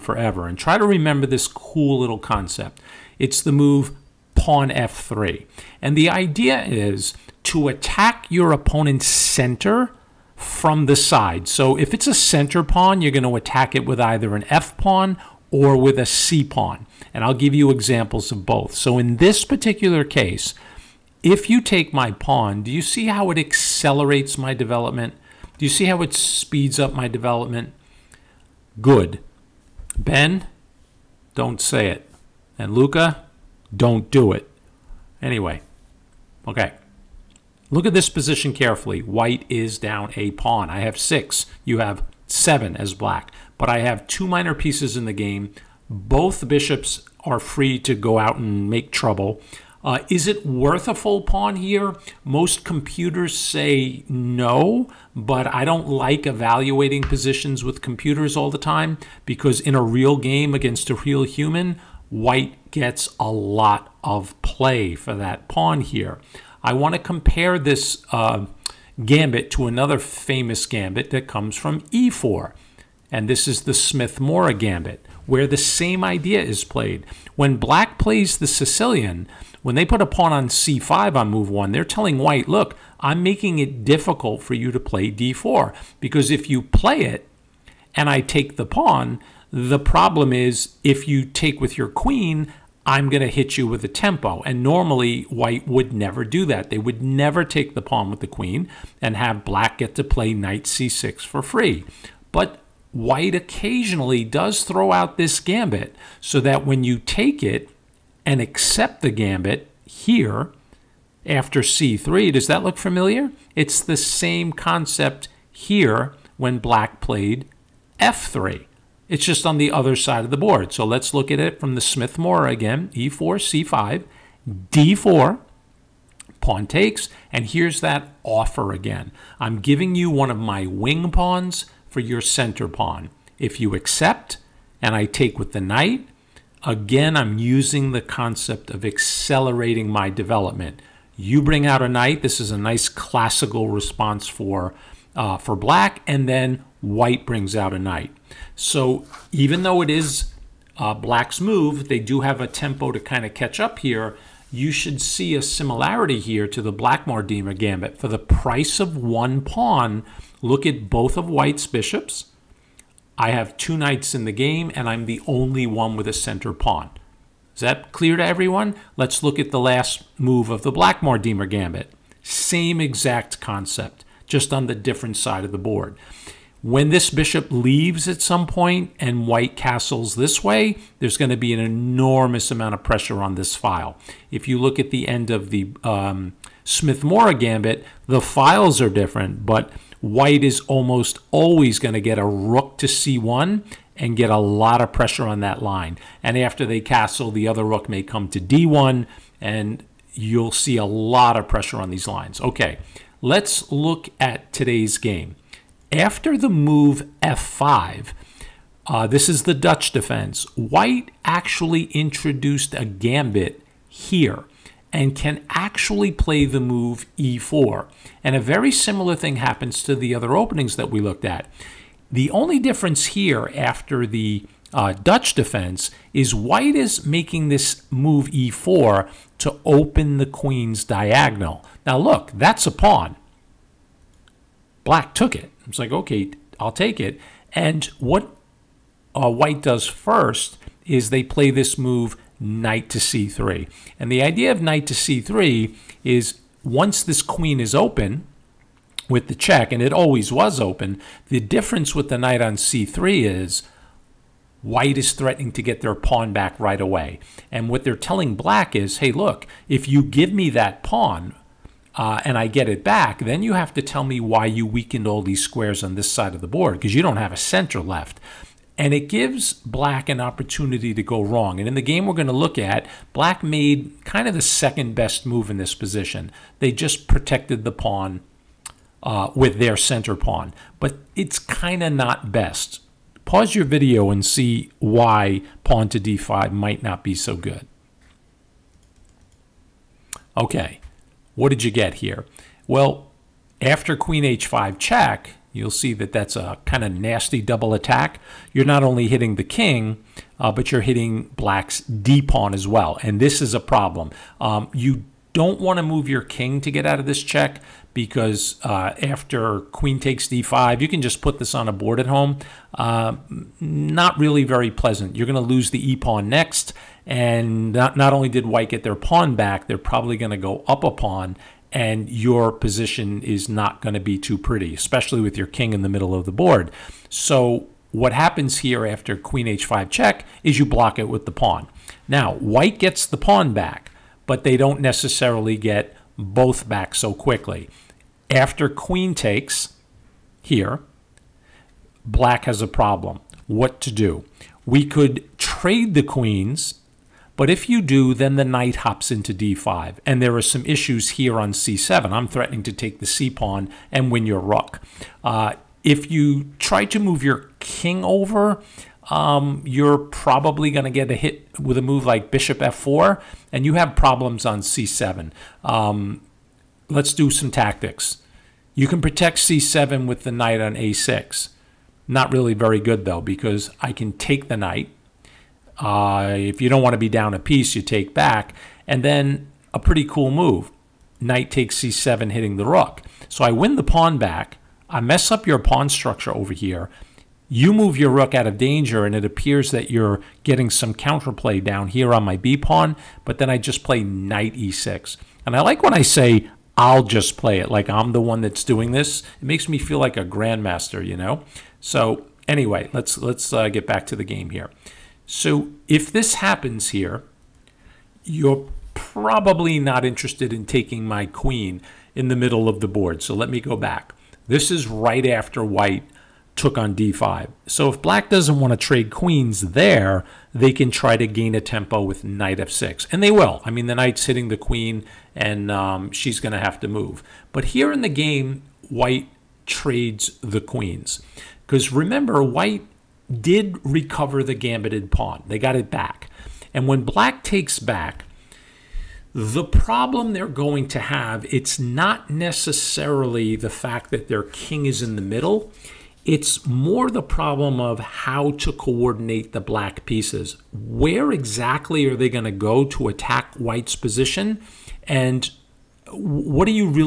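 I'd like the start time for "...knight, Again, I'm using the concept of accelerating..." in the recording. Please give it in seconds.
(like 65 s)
135 s.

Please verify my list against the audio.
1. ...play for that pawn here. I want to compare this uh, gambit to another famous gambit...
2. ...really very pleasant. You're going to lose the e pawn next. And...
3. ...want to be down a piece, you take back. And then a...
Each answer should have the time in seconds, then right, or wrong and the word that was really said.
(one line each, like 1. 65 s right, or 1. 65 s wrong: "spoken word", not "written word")
1. 64 s right
2. 314 s right
3. 376 s right.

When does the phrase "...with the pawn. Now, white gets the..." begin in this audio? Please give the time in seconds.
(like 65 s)
331 s.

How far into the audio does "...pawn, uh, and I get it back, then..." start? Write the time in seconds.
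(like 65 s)
260 s.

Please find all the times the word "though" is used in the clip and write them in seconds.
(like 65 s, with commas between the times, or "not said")
149 s, 373 s.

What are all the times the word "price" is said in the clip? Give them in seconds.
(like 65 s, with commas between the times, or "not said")
158 s.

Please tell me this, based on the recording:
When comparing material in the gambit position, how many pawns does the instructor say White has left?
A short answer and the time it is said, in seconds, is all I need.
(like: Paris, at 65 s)
6, at 40 s.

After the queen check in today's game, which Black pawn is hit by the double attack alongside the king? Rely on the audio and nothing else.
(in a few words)
d pawn.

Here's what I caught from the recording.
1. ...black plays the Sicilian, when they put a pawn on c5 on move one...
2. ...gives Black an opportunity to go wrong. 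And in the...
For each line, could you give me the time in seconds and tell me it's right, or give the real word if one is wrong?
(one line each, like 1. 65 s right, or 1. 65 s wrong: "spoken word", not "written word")
1. 77 s right
2. 269 s right.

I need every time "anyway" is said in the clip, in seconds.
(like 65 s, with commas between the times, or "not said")
35 s, 402 s.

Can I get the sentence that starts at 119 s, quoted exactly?
It's just on the other side of the board.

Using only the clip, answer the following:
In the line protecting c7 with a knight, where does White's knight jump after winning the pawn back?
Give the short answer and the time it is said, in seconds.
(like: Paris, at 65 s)
e6, at 394 s.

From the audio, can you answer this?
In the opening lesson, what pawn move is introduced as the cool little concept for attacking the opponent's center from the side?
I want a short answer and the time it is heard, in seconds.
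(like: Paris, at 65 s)
pawn f3, at 4 s.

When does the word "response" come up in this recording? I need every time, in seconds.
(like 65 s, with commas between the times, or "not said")
143 s.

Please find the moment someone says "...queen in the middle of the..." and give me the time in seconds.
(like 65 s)
411 s.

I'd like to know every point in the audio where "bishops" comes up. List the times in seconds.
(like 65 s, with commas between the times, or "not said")
46 s, 161 s, 177 s, 362 s.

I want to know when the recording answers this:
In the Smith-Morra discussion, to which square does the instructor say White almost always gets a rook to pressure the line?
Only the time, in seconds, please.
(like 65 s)
192 s.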